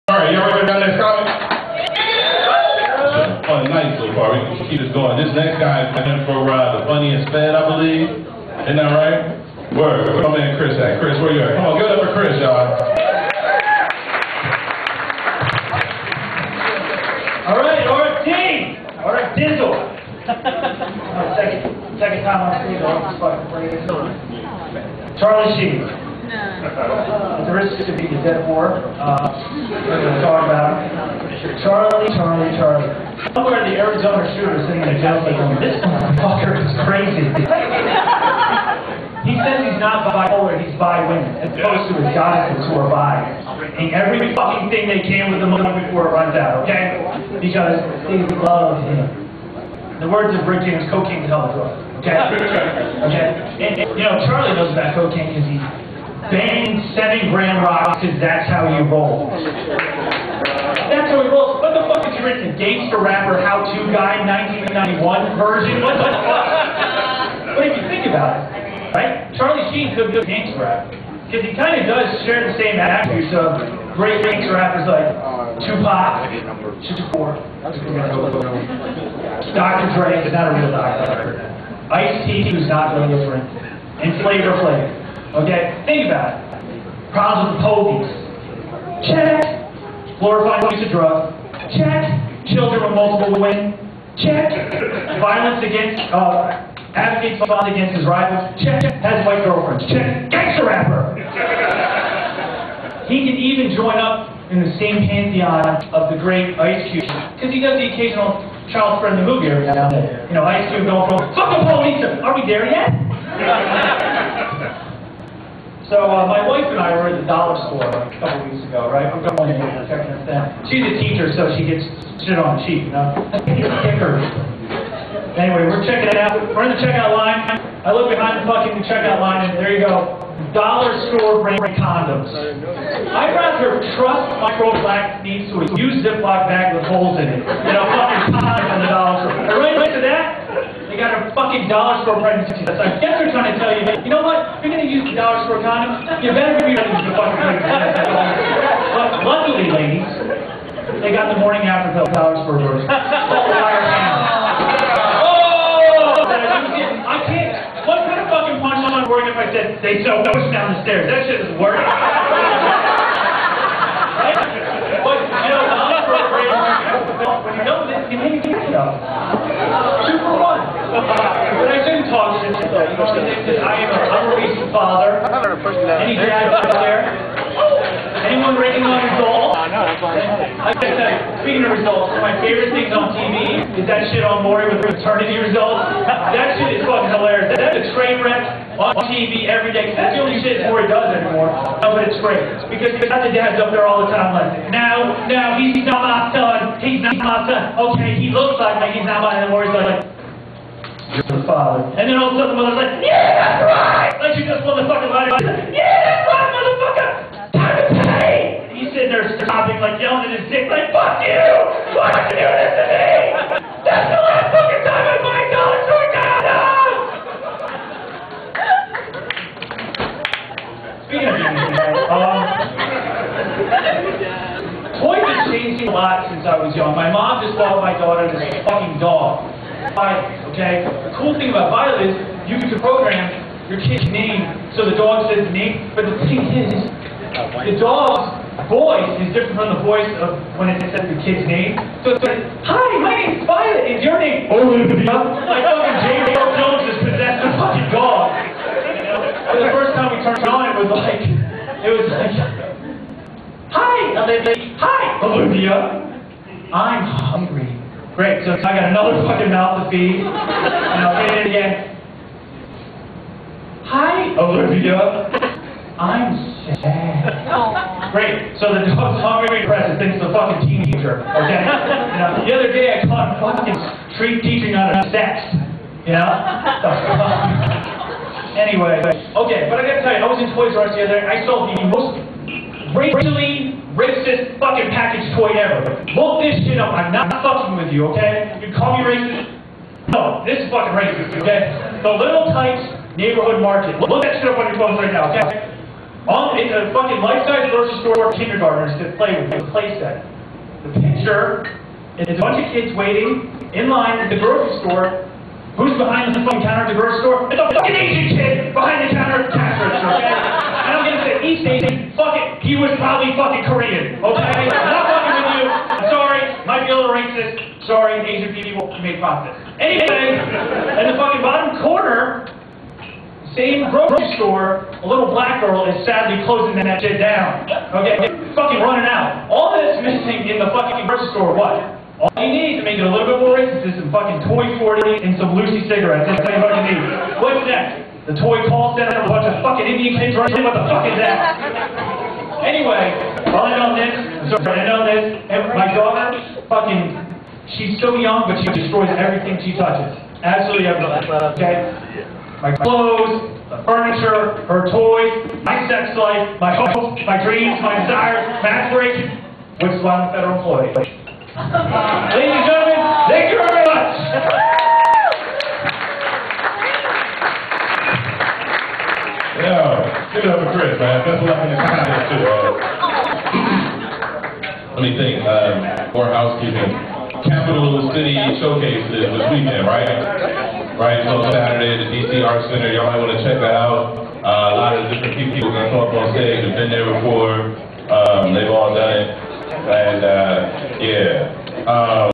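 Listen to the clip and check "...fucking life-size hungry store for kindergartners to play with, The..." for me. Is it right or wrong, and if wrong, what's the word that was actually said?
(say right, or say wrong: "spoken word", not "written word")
wrong: "grocery", not "hungry".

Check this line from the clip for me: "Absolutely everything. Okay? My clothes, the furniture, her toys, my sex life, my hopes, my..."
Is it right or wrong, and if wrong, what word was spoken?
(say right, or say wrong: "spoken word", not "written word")
right.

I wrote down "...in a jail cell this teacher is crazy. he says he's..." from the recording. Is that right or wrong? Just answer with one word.
wrong.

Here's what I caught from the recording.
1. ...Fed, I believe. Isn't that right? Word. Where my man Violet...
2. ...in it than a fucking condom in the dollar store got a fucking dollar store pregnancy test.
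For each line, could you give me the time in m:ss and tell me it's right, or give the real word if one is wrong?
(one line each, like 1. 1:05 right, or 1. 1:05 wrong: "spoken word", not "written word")
1. 0:07 wrong: "Chris", not "Violet"
2. 2:17 right.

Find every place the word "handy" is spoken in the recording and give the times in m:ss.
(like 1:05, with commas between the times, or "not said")
not said.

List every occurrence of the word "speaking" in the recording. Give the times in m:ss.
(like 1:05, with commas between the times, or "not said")
3:01, 3:41.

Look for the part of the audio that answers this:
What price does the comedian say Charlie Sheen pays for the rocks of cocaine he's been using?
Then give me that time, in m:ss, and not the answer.
0:56.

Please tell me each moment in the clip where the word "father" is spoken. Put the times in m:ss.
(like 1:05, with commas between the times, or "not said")
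2:54, 3:21.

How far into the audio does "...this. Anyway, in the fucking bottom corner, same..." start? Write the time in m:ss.
5:19.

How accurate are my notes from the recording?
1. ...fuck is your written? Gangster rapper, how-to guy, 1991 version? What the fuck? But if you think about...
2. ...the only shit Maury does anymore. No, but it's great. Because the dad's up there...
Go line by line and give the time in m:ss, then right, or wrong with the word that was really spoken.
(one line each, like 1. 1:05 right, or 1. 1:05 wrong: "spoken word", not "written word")
1. 1:01 right
2. 3:10 right.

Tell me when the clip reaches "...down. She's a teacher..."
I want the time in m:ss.
2:00.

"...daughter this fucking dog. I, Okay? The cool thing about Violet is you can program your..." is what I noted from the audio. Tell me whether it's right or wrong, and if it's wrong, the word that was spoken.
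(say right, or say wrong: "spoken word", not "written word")
right.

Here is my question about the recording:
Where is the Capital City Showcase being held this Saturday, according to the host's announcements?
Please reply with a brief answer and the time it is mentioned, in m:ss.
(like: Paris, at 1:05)
DC Arts Center, at 6:22.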